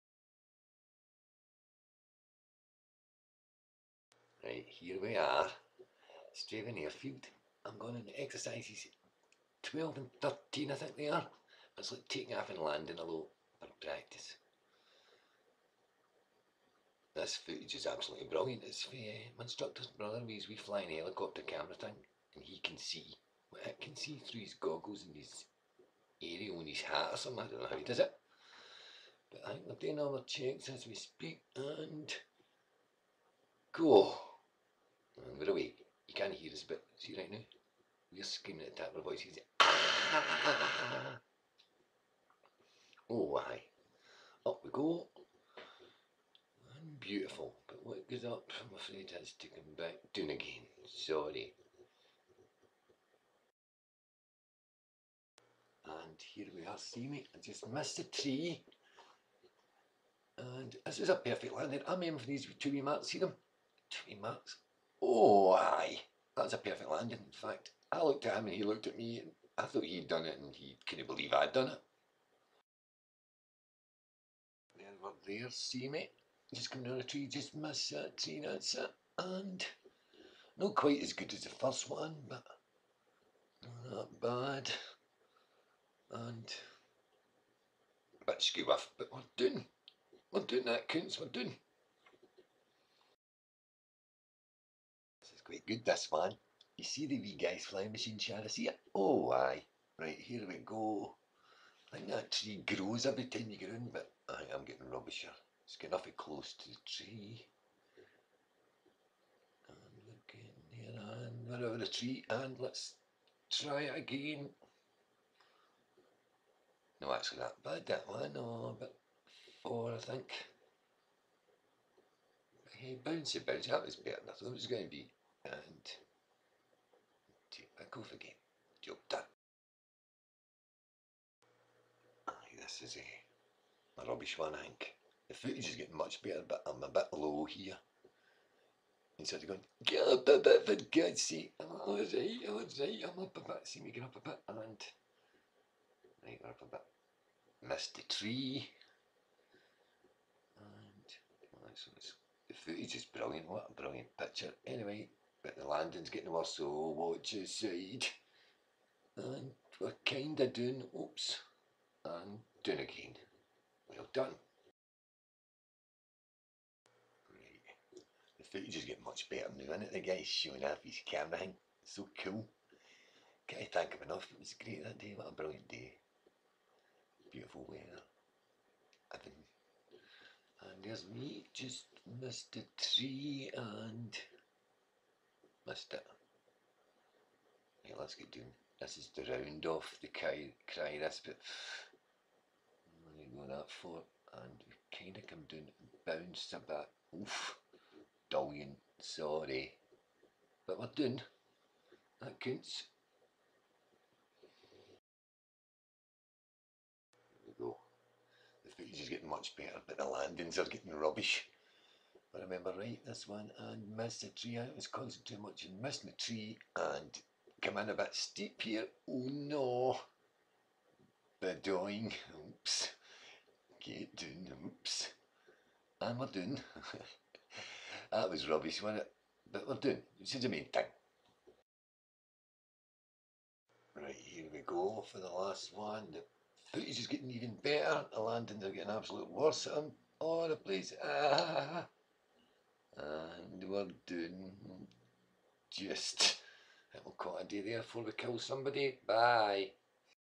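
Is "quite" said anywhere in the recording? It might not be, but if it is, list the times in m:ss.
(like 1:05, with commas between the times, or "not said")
1:20, 1:35, 4:07.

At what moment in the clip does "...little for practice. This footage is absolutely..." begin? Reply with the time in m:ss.
0:13.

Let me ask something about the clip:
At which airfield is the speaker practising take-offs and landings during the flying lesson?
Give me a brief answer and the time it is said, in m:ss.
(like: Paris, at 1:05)
Strathaven Airfield, at 0:06.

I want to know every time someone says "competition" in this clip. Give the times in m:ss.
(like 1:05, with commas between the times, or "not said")
not said.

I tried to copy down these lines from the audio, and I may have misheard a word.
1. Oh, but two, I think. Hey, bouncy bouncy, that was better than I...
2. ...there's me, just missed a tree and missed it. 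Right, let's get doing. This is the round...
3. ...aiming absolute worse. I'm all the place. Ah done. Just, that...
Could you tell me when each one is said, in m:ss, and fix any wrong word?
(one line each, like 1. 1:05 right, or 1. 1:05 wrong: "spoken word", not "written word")
1. 1:58 wrong: "four", not "two"
2. 3:00 right
3. 3:58 wrong: "getting", not "aiming".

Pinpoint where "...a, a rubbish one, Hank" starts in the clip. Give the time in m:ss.
2:12.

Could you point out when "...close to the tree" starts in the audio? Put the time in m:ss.
1:46.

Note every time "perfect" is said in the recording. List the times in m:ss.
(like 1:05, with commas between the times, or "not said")
1:01, 1:06.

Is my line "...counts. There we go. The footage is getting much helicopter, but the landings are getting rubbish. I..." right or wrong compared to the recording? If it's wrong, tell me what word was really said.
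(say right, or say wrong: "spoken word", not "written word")
wrong: "better", not "helicopter".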